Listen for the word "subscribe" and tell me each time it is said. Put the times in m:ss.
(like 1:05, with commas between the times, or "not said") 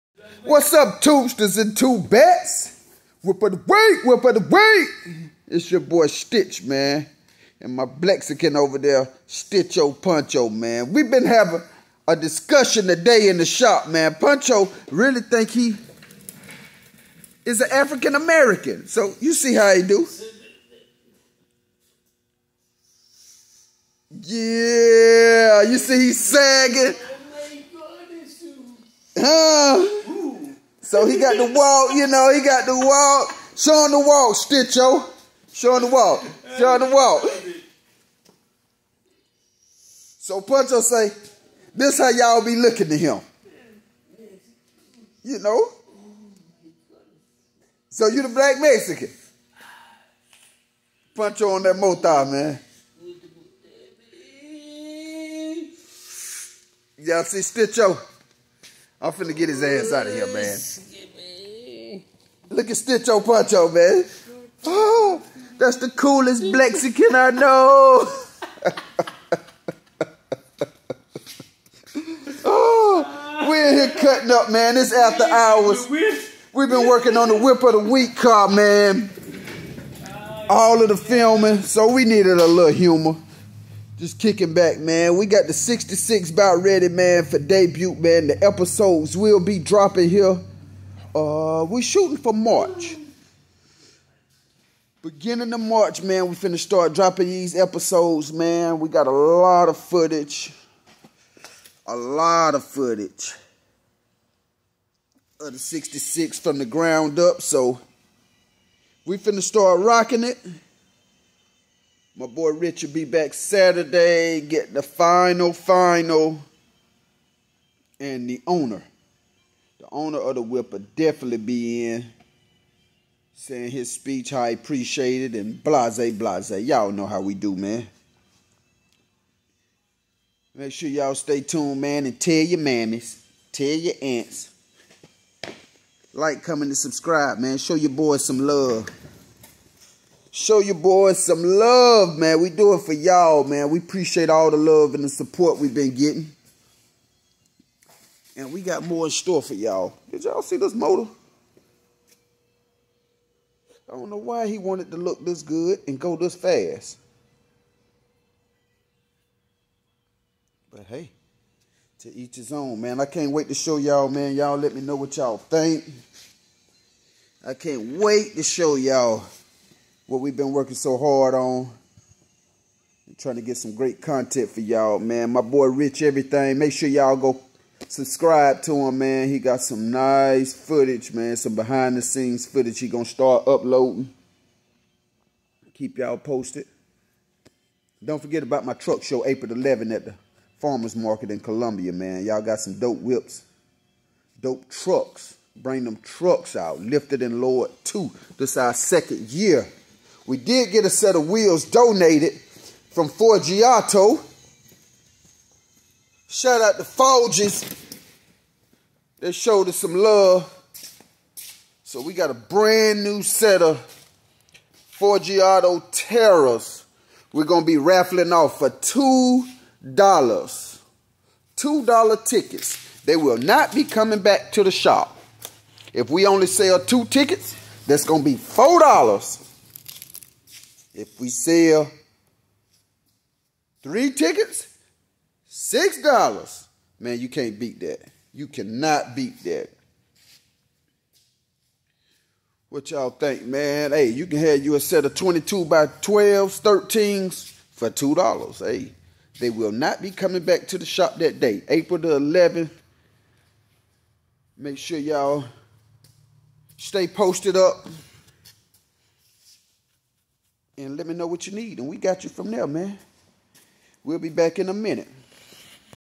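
2:16, 2:57.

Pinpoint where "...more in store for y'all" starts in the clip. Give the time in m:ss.
2:28.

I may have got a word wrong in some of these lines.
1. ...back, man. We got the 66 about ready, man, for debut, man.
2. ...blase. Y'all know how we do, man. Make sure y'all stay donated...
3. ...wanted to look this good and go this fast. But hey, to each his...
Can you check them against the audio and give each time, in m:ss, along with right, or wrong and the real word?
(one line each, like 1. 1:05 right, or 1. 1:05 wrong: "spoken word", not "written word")
1. 1:24 right
2. 2:06 wrong: "tuned", not "donated"
3. 2:34 right.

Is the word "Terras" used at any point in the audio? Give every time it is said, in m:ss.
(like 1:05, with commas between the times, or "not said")
3:35.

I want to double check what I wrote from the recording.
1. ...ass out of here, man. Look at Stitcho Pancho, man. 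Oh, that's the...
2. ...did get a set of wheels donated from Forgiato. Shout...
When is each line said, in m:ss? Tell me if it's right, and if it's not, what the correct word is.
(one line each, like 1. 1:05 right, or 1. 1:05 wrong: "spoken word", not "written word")
1. 0:59 right
2. 3:20 right.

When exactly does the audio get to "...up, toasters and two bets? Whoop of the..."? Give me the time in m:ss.
0:00.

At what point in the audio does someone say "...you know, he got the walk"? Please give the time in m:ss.
0:31.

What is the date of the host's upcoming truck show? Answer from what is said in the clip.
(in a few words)
April 11.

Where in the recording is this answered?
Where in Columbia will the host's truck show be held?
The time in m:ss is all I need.
3:10.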